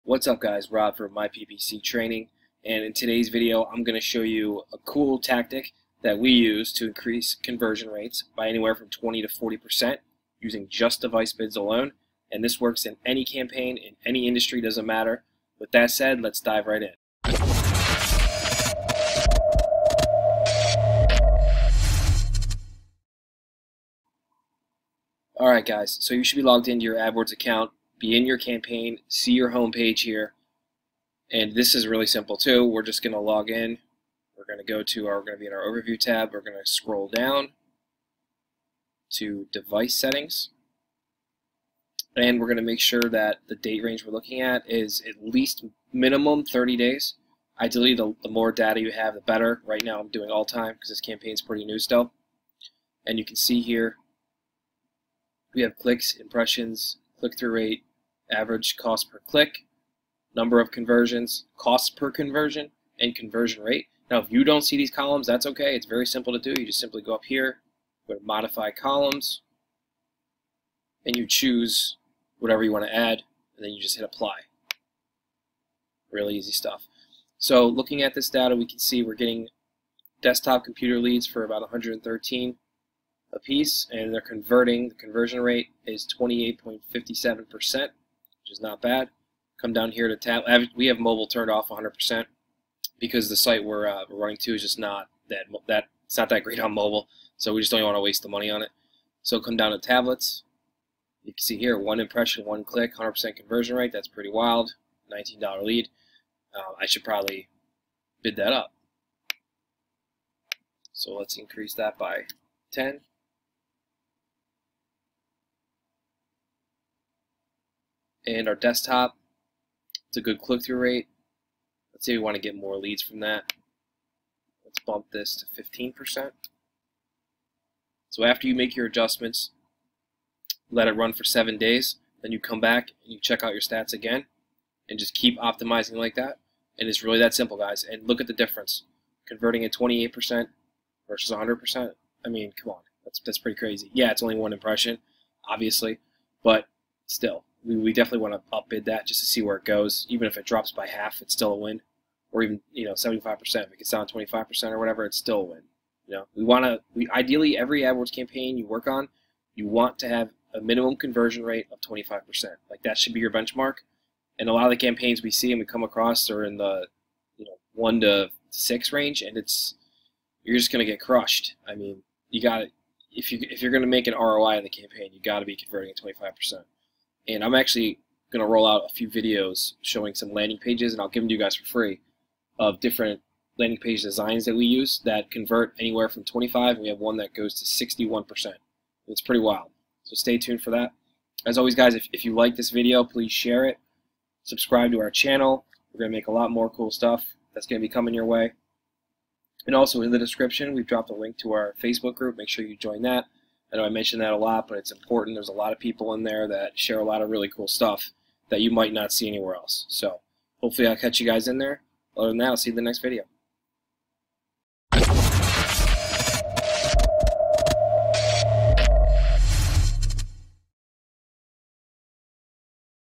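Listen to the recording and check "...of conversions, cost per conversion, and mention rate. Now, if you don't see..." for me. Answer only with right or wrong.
wrong.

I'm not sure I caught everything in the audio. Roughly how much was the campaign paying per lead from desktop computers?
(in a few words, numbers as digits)
113.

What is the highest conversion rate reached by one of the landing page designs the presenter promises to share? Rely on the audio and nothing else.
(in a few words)
61%.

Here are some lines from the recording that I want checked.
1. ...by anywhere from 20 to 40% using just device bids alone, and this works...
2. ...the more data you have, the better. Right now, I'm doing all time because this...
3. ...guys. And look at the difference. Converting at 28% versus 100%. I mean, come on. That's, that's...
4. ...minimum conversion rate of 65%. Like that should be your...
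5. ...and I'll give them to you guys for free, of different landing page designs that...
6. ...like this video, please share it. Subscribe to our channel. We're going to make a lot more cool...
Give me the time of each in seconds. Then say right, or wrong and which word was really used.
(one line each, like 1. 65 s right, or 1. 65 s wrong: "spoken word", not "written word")
1. 8 s right
2. 48 s right
3. 137 s right
4. 160 s wrong: "25", not "65"
5. 180 s right
6. 192 s right.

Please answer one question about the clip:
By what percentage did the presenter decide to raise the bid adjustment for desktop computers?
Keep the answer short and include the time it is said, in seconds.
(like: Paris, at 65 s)
15%, at 125 s.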